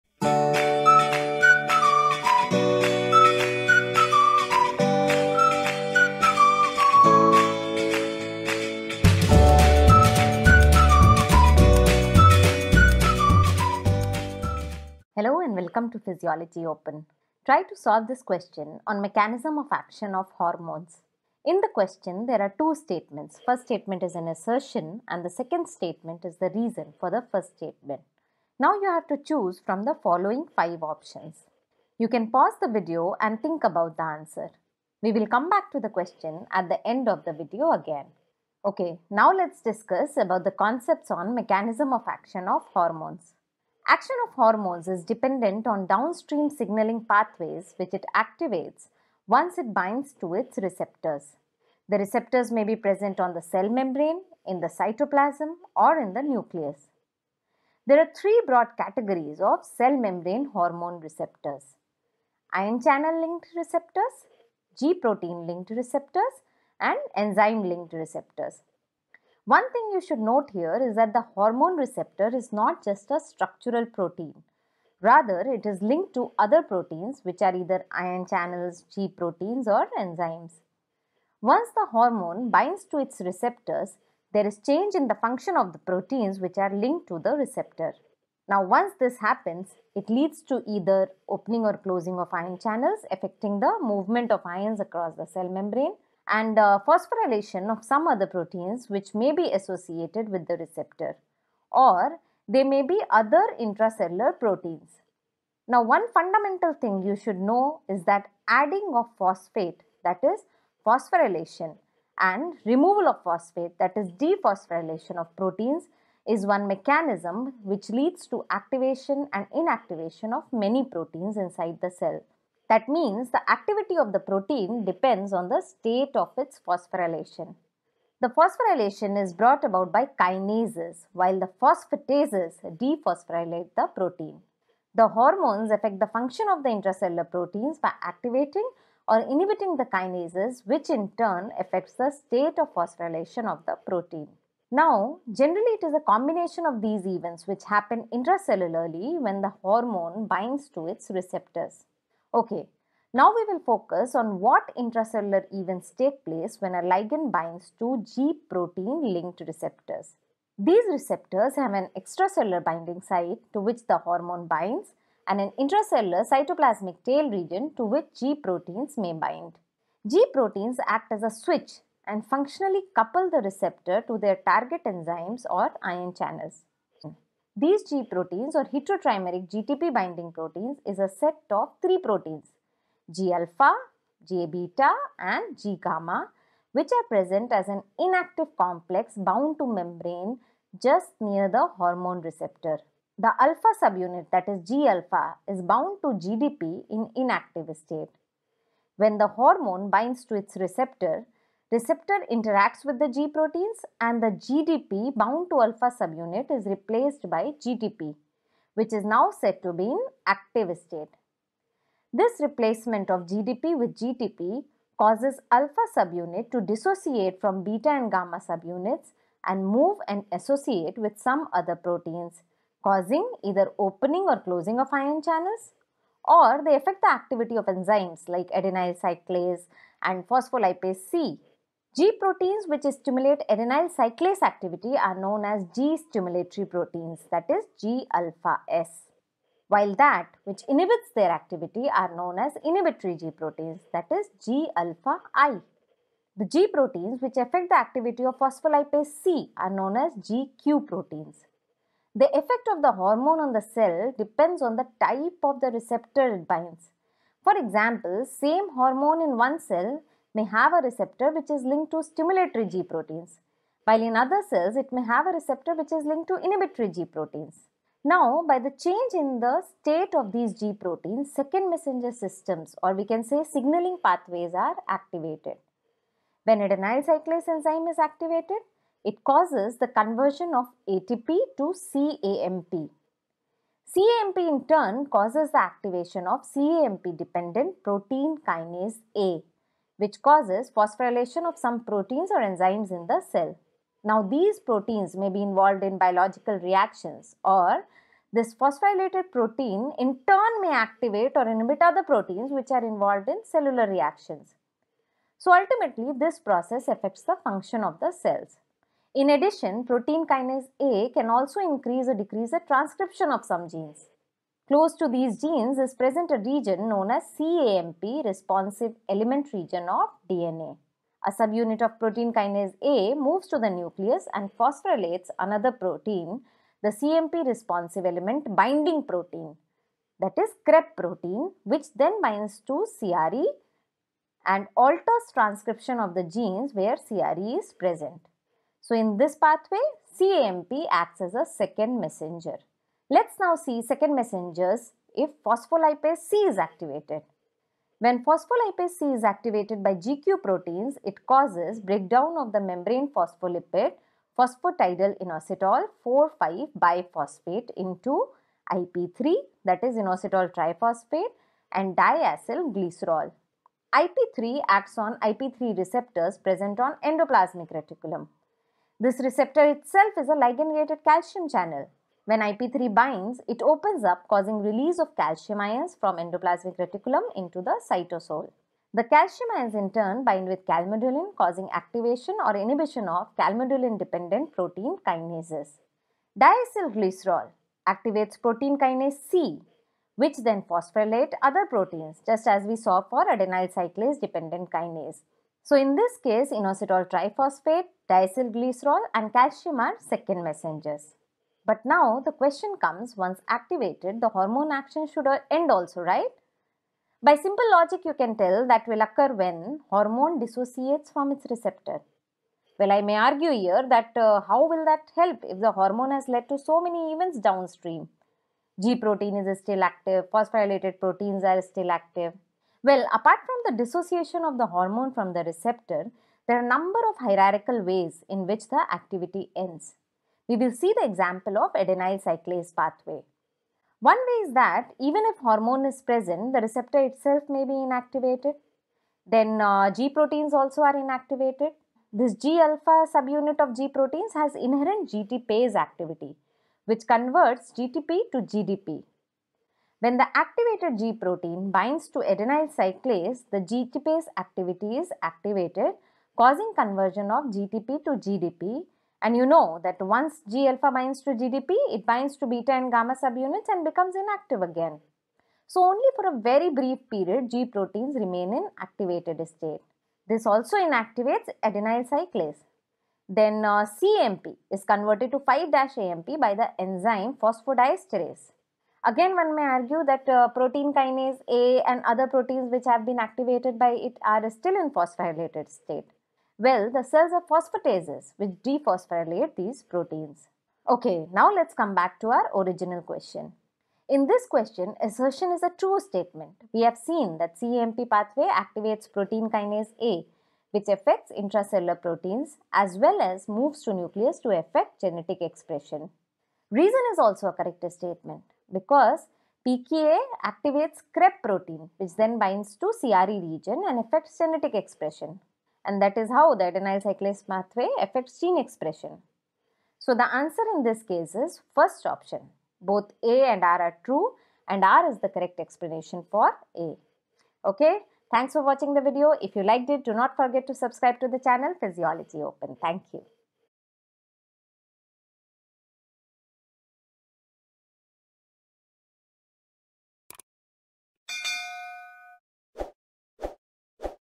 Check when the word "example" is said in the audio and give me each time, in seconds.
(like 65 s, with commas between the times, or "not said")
257 s, 431 s.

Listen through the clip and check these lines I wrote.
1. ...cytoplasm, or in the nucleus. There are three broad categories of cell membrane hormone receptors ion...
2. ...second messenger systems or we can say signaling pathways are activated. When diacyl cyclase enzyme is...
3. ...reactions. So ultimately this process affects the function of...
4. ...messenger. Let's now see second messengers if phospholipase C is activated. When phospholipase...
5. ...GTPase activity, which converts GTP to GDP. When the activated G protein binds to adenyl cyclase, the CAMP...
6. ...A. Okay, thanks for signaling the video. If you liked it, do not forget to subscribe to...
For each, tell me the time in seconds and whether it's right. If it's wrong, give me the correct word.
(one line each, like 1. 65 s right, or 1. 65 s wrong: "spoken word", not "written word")
1. 54 s right
2. 271 s wrong: "adenyl", not "diacyl"
3. 303 s right
4. 341 s right
5. 445 s wrong: "GTPase", not "CAMP"
6. 526 s wrong: "watching", not "signaling".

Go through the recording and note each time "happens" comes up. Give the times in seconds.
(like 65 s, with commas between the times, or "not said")
89 s, 147 s.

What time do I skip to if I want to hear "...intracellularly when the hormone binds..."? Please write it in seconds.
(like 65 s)
148 s.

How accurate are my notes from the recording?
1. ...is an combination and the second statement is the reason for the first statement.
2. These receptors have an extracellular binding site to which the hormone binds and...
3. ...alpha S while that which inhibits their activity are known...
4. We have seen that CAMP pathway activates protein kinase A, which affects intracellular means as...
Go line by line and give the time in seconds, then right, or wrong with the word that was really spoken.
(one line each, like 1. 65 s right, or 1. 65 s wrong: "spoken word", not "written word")
1. 24 s wrong: "assertion", not "combination"
2. 160 s right
3. 238 s right
4. 496 s wrong: "proteins", not "means".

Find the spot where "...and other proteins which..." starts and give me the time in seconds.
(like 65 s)
481 s.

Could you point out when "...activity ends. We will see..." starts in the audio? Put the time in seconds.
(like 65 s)
428 s.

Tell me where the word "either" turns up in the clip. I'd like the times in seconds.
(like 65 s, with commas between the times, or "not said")
77 s, 90 s, 223 s.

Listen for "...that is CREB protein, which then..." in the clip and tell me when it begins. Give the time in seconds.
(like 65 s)
330 s.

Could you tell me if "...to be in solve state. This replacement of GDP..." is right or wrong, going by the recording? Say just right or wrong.
wrong.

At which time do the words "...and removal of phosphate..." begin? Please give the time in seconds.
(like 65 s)
112 s.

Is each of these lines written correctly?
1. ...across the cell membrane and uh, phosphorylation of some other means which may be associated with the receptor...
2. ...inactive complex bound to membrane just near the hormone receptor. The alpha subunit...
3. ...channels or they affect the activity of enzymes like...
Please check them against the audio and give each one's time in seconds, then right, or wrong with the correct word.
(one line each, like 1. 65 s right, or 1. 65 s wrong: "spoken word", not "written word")
1. 94 s wrong: "proteins", not "means"
2. 187 s right
3. 225 s right.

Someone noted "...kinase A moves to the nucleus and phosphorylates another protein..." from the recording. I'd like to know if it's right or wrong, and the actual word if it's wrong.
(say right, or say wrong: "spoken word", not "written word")
right.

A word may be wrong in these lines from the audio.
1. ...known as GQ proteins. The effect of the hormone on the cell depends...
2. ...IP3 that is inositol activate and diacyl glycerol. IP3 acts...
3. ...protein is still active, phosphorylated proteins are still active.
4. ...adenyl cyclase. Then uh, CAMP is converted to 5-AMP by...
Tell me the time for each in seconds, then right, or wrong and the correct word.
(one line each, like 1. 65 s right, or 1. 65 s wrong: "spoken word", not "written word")
1. 249 s right
2. 358 s wrong: "triphosphate", not "activate"
3. 418 s right
4. 471 s right.